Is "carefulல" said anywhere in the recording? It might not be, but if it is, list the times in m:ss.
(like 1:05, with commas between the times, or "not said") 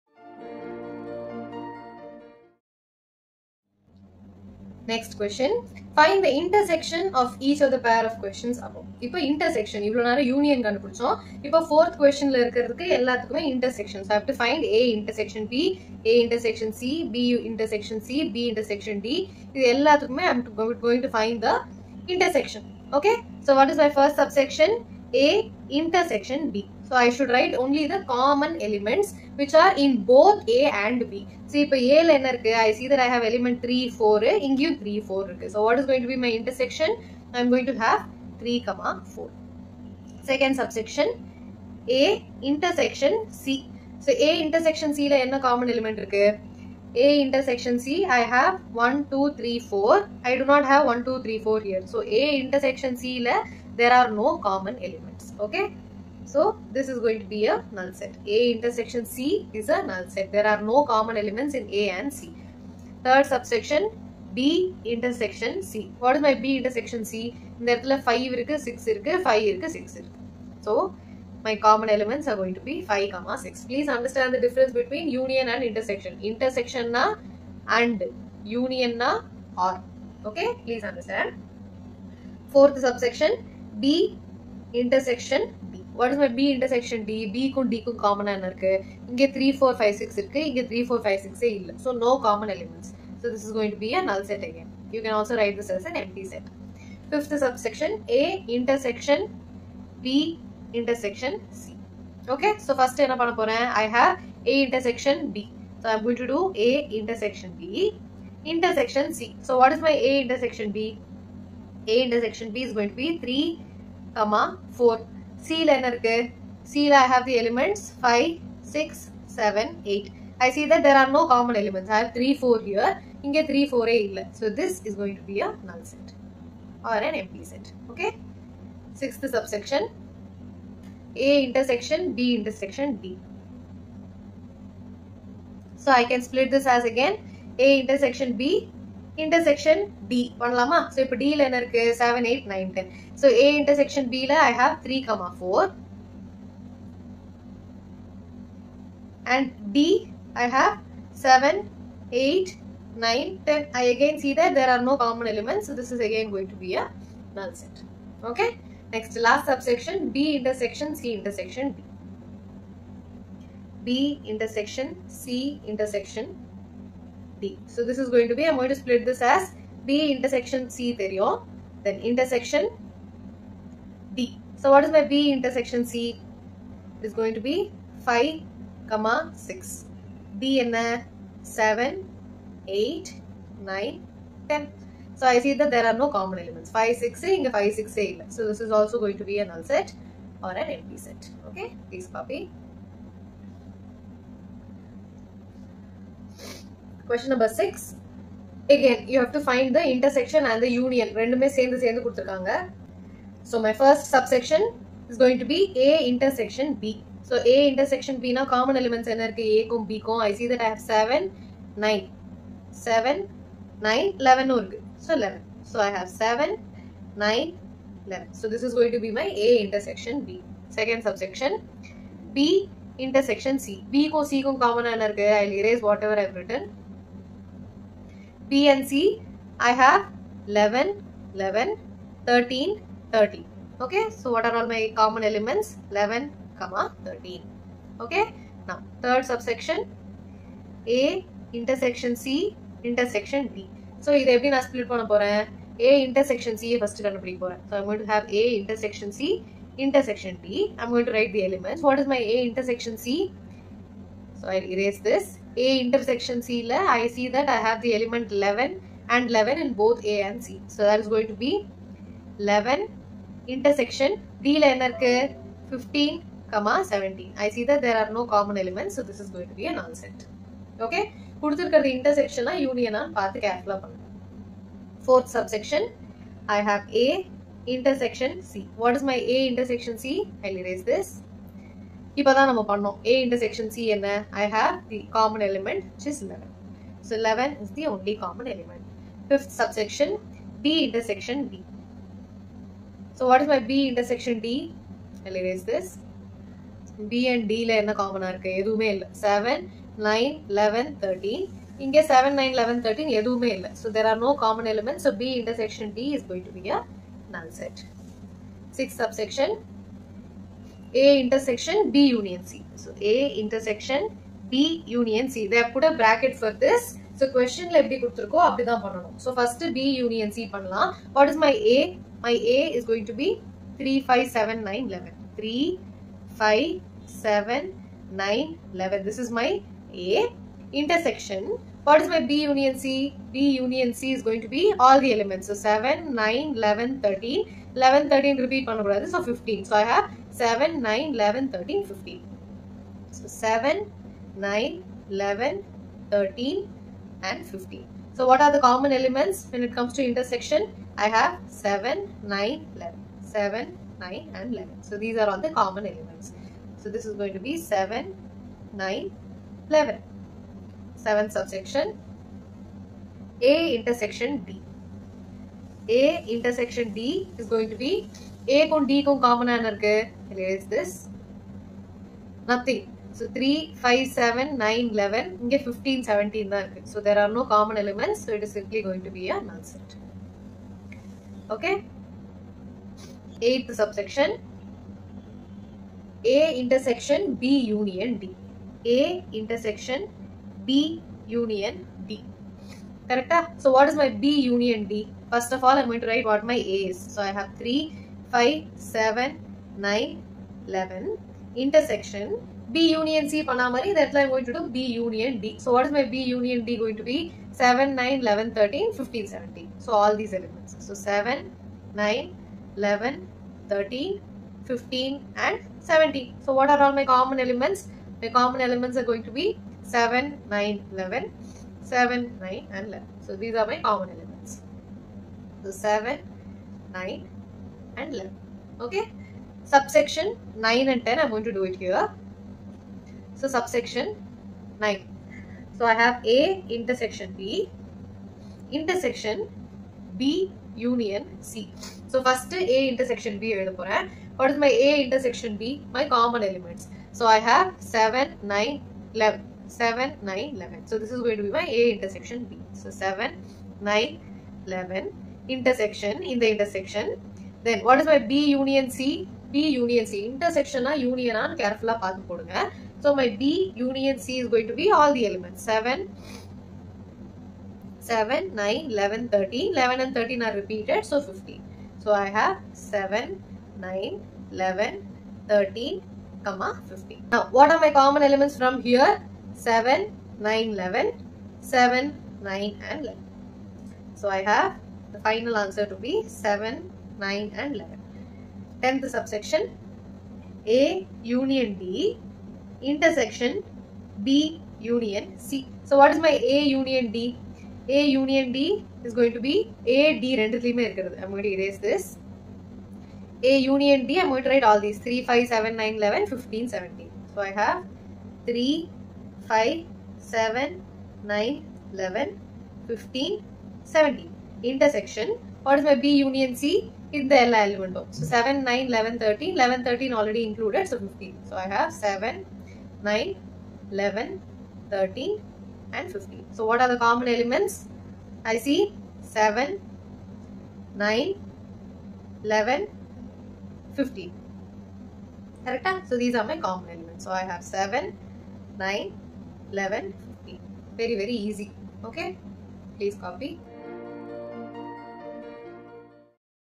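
4:33.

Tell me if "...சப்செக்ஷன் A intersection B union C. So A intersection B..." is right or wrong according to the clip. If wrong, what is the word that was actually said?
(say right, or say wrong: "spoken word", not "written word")
right.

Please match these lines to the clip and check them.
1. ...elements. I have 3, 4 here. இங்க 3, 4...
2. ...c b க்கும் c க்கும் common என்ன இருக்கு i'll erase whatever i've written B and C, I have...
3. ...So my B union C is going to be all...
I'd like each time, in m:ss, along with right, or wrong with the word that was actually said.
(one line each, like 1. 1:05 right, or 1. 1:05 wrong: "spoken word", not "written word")
1. 2:01 right
2. 3:43 right
3. 7:43 right.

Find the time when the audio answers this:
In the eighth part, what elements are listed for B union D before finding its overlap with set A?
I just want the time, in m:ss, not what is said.
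6:47.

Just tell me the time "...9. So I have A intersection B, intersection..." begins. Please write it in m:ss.
7:14.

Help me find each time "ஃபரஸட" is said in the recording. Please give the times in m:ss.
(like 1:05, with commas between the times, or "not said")
0:23, 1:42.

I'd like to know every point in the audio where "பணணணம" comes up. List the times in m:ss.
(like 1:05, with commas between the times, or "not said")
5:18.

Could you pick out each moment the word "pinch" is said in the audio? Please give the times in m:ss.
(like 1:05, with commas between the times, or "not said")
not said.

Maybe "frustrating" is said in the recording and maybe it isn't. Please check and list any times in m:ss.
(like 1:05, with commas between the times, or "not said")
not said.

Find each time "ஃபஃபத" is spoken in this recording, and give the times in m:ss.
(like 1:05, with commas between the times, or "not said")
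1:37, 4:49.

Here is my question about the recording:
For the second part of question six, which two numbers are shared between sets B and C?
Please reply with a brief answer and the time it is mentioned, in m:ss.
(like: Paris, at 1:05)
11, 13, at 3:55.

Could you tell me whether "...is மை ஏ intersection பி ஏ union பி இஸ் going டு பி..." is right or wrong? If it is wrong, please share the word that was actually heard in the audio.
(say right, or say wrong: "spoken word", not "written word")
wrong: "intersection", not "union".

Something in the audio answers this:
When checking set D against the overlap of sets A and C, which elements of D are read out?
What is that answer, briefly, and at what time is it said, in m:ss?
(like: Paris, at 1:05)
15, 17, at 4:25.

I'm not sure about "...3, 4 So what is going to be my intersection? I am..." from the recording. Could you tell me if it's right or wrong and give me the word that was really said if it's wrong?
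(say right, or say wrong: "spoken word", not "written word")
right.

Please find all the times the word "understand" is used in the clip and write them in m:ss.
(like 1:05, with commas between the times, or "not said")
1:13, 1:20.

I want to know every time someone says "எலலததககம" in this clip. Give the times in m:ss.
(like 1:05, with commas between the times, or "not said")
0:12, 0:19.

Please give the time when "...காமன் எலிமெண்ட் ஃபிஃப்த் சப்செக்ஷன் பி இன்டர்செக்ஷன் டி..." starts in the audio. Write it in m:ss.
4:48.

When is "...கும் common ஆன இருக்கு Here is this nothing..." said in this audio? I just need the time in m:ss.
6:09.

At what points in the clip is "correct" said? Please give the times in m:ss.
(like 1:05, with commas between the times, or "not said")
6:33, 8:55.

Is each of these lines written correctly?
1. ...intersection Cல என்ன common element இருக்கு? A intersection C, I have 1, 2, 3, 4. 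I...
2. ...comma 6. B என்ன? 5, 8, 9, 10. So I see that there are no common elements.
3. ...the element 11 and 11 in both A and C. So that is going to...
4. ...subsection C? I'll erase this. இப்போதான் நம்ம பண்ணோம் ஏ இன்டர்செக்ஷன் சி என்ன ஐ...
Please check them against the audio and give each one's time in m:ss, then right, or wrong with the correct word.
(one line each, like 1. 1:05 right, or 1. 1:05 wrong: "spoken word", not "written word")
1. 0:44 right
2. 2:58 wrong: "7", not "5"
3. 4:17 right
4. 4:39 wrong: "intersection", not "subsection".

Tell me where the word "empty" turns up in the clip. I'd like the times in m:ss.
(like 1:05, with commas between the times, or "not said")
2:07, 3:10.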